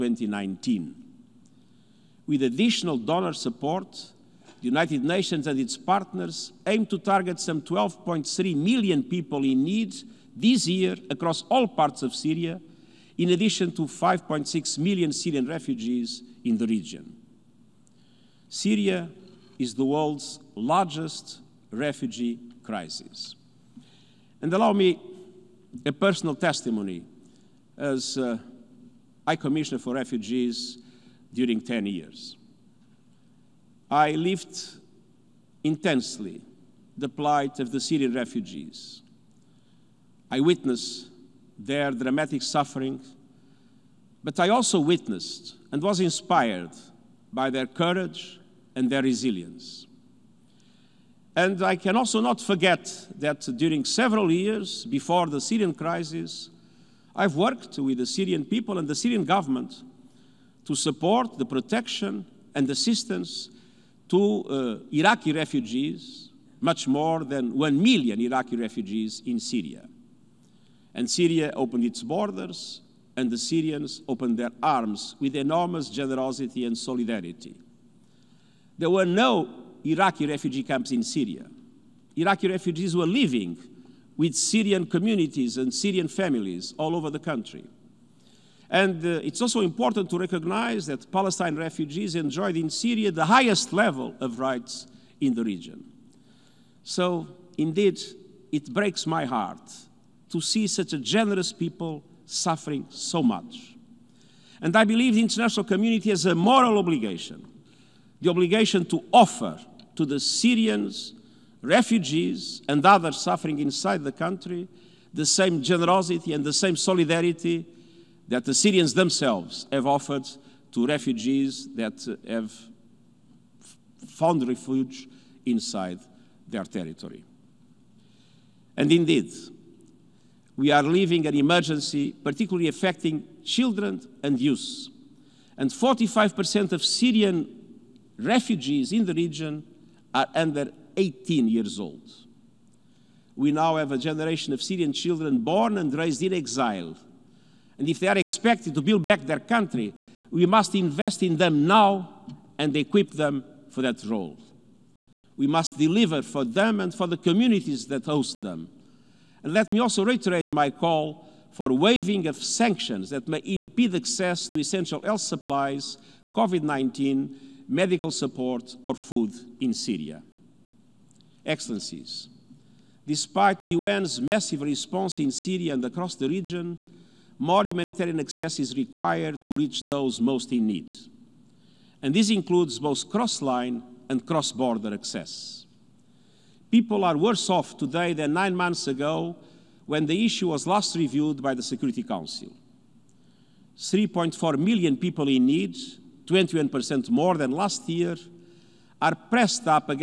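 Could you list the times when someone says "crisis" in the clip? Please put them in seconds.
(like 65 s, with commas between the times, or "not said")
22 s, 55 s.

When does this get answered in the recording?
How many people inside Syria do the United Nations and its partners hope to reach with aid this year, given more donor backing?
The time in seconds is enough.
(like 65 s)
7 s.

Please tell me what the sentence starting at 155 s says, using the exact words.
We must deliver for them and for the communities that host them.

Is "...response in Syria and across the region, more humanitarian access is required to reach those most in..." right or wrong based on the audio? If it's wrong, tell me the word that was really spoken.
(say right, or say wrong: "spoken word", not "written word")
right.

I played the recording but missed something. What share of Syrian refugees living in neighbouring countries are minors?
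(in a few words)
45%.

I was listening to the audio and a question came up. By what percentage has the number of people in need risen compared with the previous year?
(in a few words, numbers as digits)
21%.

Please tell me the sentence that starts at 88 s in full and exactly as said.
And uh, it's also important to recognize that Palestine refugees enjoyed in Syria the highest level of rights in the region.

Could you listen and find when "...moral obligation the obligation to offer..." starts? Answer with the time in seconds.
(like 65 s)
106 s.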